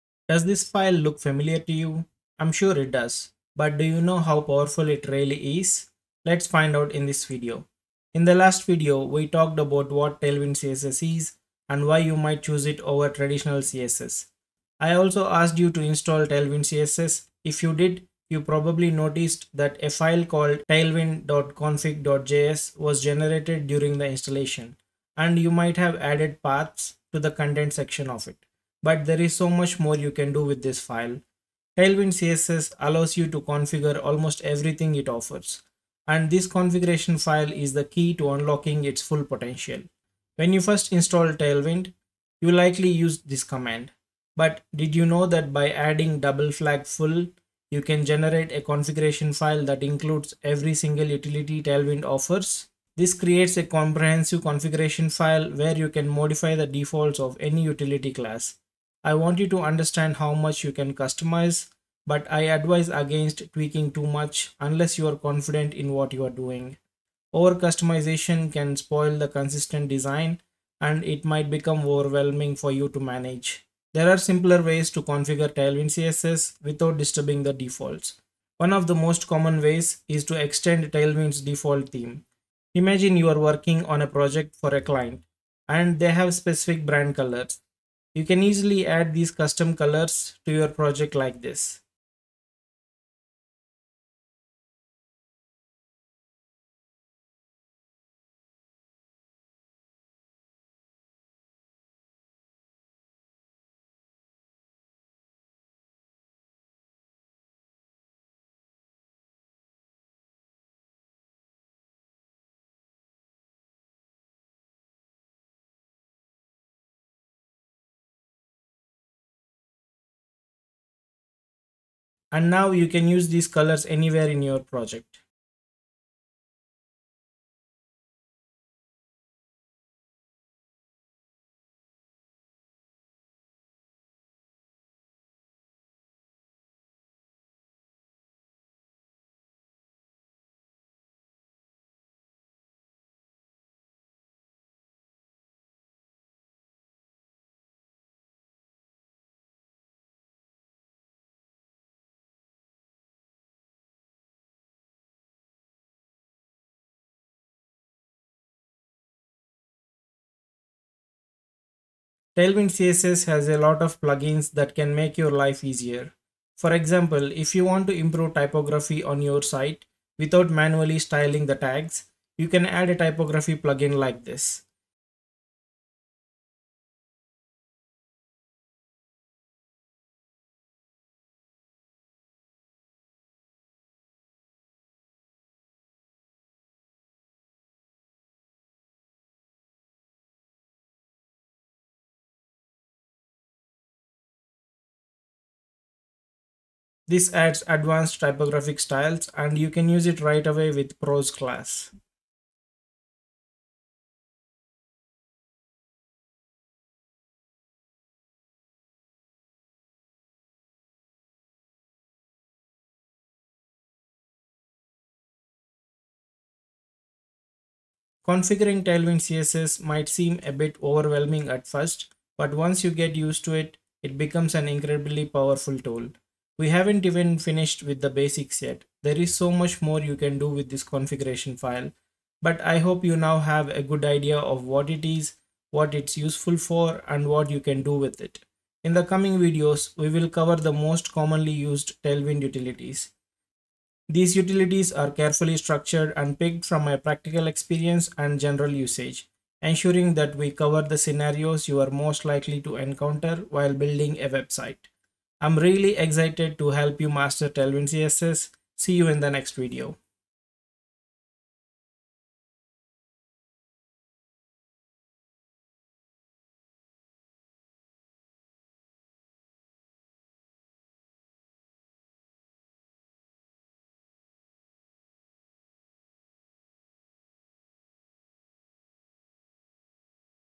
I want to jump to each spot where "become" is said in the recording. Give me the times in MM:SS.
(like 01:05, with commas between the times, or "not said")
01:11, 03:44.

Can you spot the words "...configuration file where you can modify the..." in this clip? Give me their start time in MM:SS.
00:54.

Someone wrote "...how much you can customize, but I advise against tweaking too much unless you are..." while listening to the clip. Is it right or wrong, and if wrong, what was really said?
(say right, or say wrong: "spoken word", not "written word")
right.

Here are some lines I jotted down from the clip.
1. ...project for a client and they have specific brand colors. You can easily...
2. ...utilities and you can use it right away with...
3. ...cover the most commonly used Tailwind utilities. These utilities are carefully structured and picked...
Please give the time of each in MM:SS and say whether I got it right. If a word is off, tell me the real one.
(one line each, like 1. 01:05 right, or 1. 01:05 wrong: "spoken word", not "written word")
1. 01:24 right
2. 03:18 wrong: "styles", not "utilities"
3. 04:00 right.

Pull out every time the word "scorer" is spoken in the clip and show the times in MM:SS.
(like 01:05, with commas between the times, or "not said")
not said.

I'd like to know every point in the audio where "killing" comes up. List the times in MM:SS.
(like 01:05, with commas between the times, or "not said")
not said.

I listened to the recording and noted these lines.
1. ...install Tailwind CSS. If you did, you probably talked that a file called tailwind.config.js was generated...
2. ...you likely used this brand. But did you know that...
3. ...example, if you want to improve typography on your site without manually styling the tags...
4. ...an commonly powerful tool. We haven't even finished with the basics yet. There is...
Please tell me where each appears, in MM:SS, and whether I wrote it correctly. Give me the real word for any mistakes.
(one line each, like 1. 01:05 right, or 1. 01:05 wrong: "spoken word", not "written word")
1. 00:15 wrong: "noticed", not "talked"
2. 00:42 wrong: "command", not "brand"
3. 02:46 right
4. 03:44 wrong: "incredibly", not "commonly".